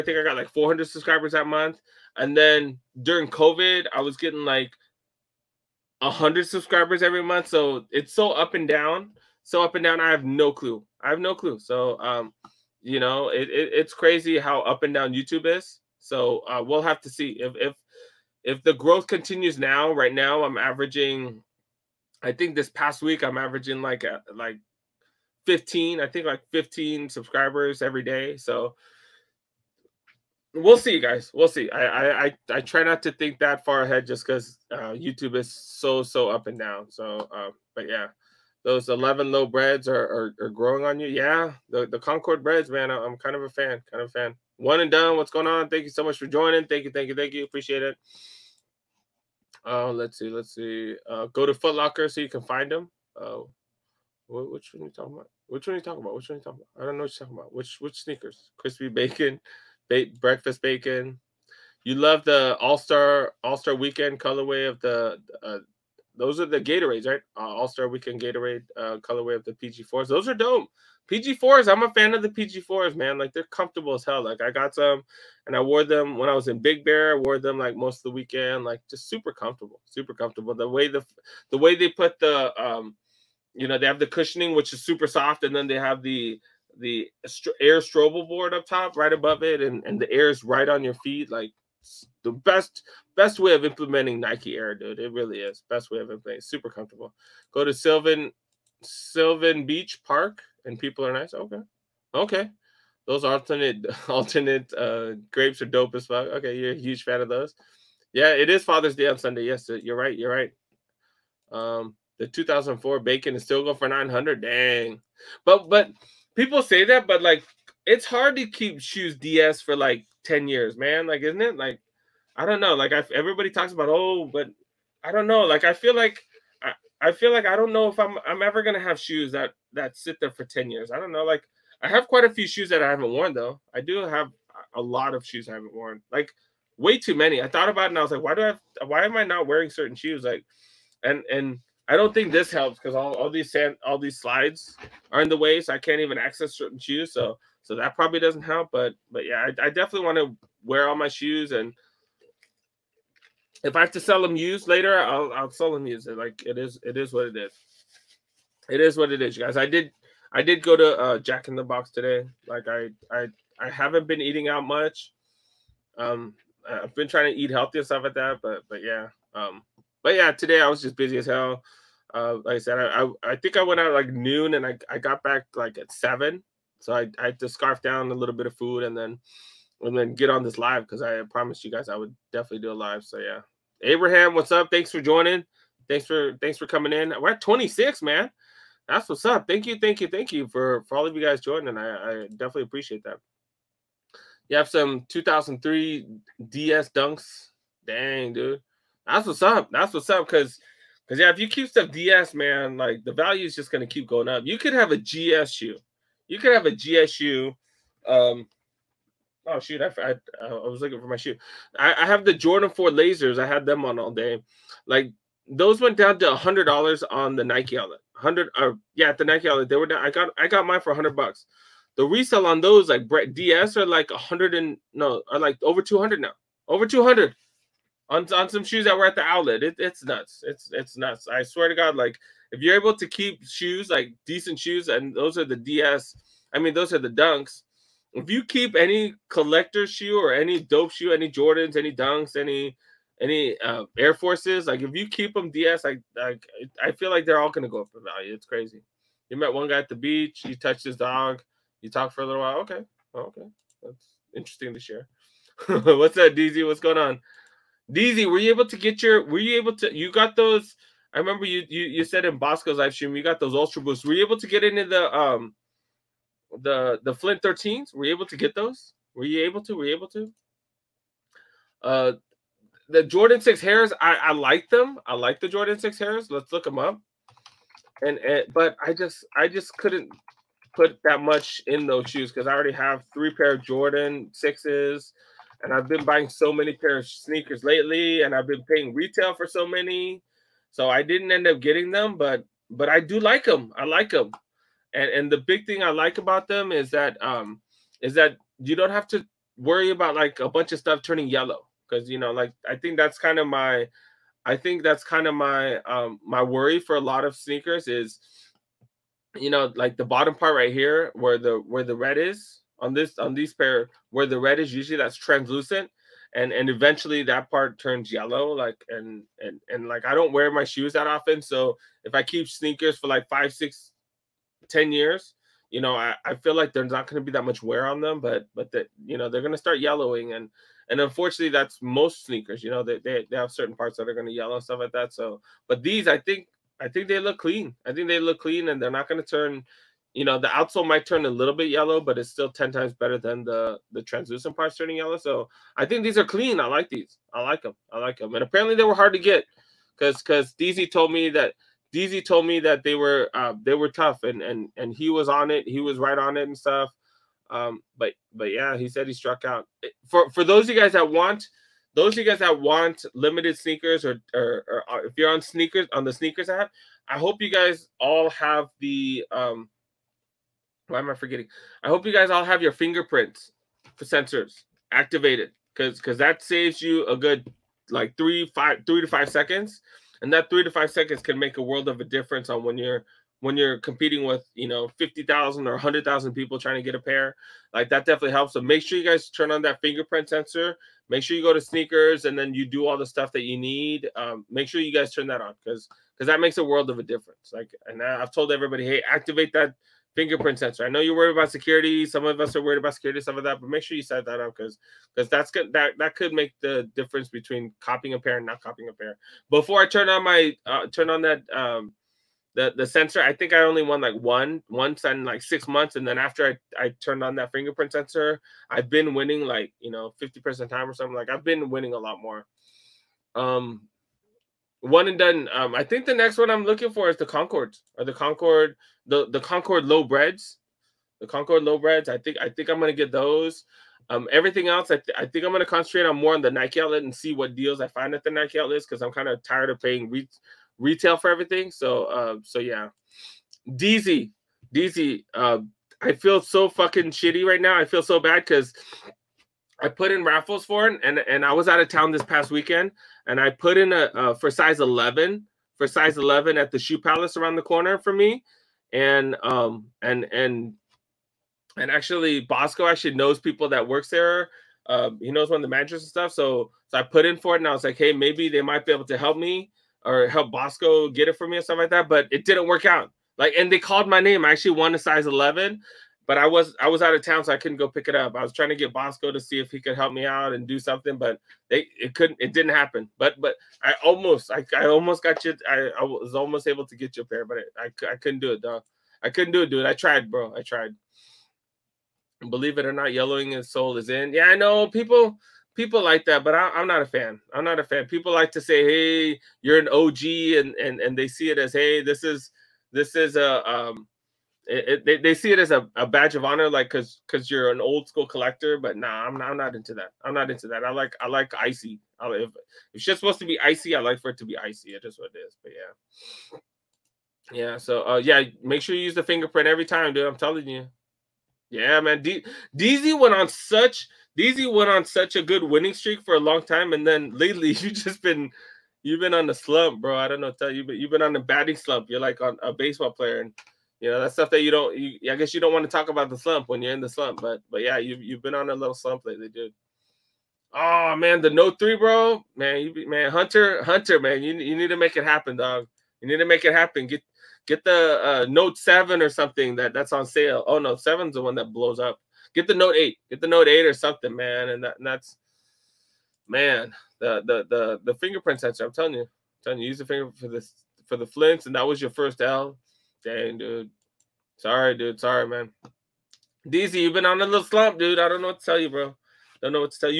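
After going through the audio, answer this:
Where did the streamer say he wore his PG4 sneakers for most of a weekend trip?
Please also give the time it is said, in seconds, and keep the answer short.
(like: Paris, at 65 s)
Big Bear, at 76 s.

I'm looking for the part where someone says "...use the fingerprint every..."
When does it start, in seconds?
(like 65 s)
519 s.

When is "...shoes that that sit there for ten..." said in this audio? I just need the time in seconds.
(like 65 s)
128 s.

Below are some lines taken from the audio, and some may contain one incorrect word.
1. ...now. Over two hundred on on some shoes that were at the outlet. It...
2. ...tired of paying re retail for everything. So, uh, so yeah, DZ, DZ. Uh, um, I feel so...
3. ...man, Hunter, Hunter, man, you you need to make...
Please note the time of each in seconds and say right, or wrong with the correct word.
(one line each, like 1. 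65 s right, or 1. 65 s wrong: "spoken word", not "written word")
1. 226 s right
2. 439 s right
3. 543 s right.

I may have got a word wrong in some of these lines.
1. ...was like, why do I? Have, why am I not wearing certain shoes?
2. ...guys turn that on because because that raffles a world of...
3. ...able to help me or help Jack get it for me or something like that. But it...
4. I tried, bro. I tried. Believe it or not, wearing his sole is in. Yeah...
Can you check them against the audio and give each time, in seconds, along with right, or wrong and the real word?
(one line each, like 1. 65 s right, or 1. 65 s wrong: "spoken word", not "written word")
1. 138 s right
2. 394 s wrong: "makes", not "raffles"
3. 468 s wrong: "Bosco", not "Jack"
4. 489 s wrong: "yellowing", not "wearing".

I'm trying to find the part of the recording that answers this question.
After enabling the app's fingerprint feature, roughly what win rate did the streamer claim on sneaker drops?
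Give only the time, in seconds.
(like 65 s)
420 s.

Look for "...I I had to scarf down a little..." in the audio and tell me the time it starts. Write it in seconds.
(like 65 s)
176 s.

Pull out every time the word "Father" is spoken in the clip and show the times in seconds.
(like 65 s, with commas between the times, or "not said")
108 s.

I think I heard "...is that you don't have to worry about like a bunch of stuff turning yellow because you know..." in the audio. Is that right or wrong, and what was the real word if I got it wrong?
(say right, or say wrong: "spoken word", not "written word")
right.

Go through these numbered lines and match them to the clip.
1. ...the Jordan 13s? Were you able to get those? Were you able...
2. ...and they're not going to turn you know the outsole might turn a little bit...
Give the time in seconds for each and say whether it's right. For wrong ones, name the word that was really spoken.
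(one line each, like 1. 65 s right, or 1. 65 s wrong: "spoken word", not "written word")
1. 267 s wrong: "Flint", not "Jordan"
2. 338 s right.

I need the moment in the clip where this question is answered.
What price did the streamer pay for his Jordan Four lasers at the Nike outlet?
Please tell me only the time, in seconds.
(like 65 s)
220 s.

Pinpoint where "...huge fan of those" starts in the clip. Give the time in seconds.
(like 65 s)
106 s.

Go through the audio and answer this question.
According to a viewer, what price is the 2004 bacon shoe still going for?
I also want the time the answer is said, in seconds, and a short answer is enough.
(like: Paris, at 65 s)
900, at 113 s.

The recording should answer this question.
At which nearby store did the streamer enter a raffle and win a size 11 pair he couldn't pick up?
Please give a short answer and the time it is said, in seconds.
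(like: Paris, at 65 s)
Shoe Palace, at 456 s.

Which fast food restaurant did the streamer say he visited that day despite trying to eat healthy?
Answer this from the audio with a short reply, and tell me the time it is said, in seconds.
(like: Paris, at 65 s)
Jack in the Box, at 161 s.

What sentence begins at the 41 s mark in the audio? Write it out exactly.
Yeah, the the Concord breads, man.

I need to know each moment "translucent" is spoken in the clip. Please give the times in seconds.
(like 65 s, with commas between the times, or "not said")
315 s, 344 s.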